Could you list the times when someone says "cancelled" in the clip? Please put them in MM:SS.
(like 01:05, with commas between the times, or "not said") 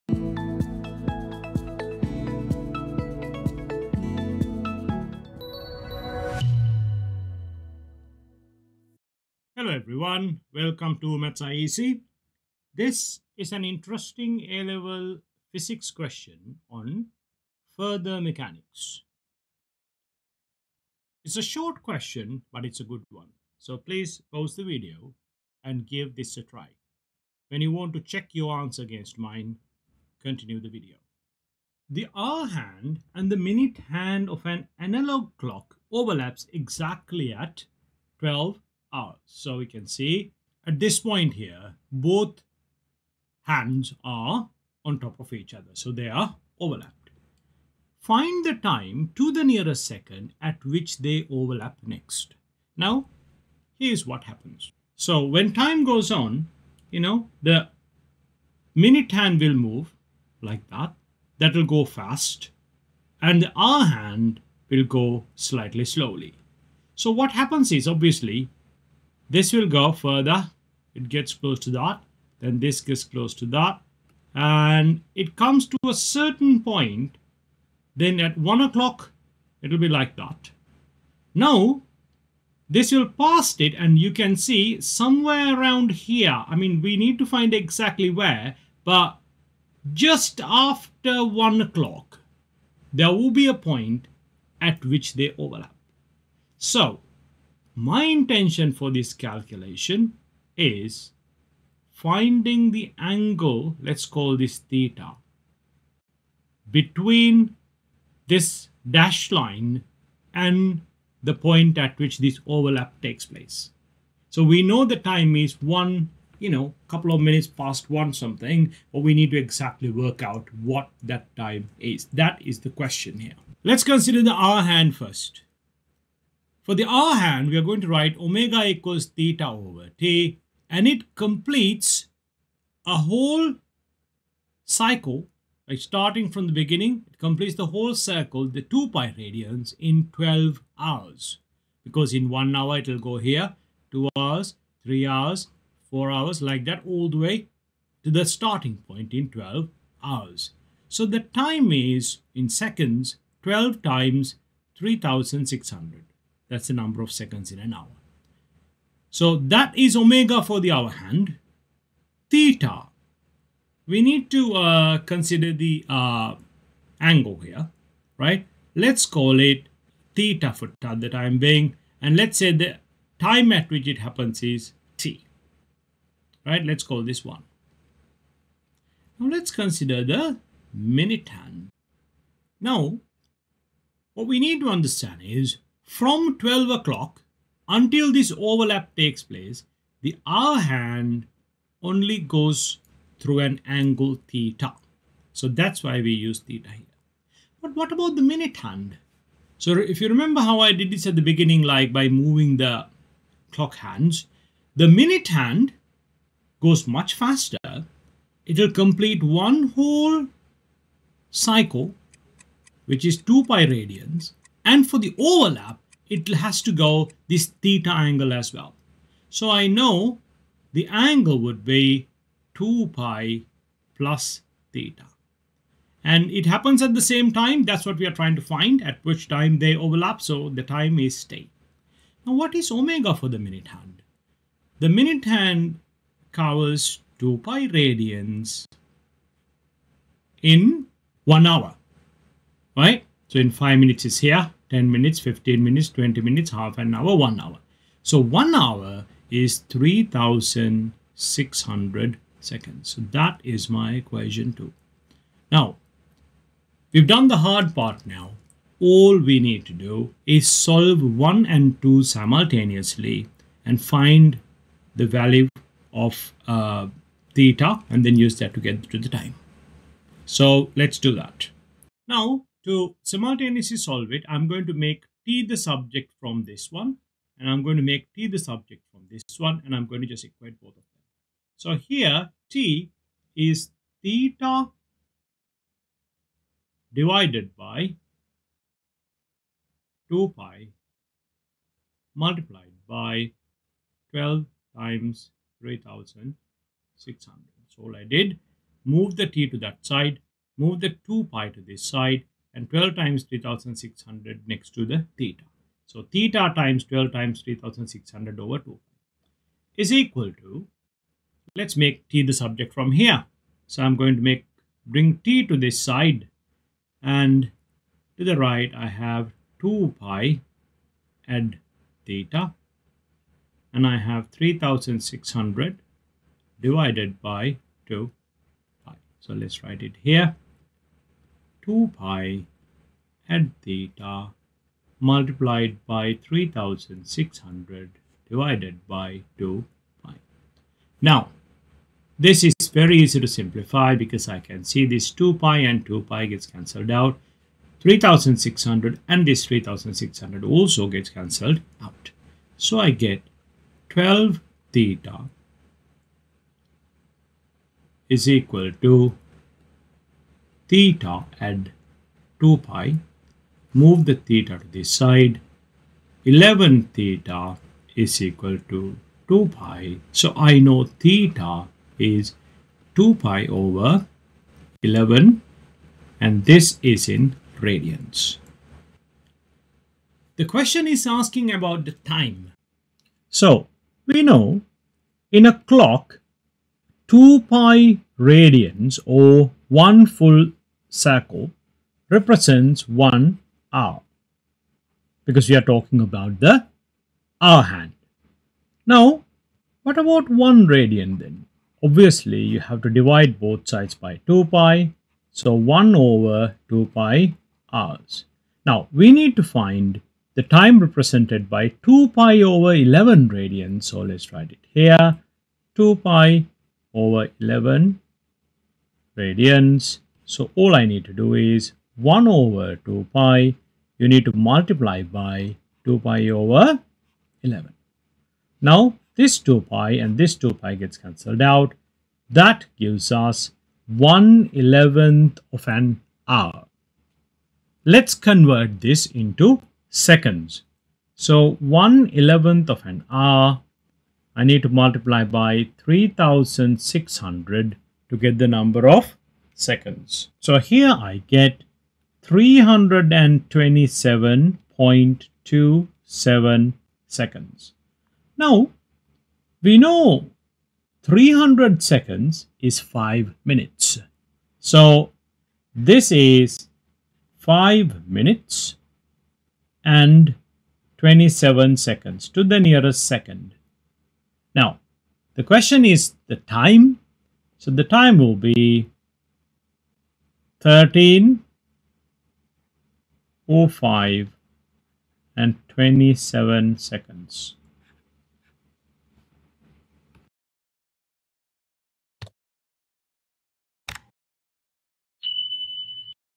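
05:46, 05:51, 07:10.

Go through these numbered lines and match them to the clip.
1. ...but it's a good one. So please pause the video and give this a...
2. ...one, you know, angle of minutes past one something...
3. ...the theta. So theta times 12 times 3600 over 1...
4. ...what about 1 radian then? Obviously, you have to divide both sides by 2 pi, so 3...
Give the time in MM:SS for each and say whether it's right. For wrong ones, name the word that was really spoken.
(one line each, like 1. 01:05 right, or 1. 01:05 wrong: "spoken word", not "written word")
1. 00:22 right
2. 01:55 wrong: "couple", not "angle"
3. 05:04 wrong: "2", not "1"
4. 06:39 wrong: "1", not "3".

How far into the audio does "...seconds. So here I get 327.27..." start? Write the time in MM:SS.
07:29.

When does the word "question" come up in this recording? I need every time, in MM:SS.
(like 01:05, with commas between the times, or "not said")
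00:15, 00:21, 02:02, 06:20, 07:55.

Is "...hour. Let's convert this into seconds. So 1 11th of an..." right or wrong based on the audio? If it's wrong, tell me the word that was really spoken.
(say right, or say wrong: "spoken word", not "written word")
right.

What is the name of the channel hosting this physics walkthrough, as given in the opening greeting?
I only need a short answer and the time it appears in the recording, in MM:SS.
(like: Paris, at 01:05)
MathSci EZ, at 00:11.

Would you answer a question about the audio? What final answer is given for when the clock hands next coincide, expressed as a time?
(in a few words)
13:05 and 27 seconds.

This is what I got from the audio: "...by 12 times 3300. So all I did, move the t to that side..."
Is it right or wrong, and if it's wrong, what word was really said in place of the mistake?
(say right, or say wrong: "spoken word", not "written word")
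wrong: "3600", not "3300".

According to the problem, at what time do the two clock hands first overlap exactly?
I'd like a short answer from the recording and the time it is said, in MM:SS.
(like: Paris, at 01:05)
12 o'clock, at 00:38.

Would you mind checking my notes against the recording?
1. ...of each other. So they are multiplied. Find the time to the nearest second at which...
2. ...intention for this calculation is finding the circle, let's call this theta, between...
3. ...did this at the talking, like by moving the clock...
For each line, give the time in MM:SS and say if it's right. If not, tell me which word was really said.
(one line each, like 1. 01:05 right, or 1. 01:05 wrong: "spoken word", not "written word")
1. 00:45 wrong: "overlapped", not "multiplied"
2. 01:38 wrong: "angle", not "circle"
3. 03:20 wrong: "beginning", not "talking".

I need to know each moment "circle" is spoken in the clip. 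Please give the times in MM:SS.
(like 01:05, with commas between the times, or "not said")
02:17, 06:30.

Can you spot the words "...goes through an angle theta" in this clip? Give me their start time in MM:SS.
03:12.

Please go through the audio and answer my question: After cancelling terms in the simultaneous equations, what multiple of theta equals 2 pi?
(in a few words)
11 theta.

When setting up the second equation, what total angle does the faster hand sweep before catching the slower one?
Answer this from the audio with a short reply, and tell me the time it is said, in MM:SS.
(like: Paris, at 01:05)
2 pi plus theta, at 03:42.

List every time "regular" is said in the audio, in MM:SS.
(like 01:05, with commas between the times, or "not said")
not said.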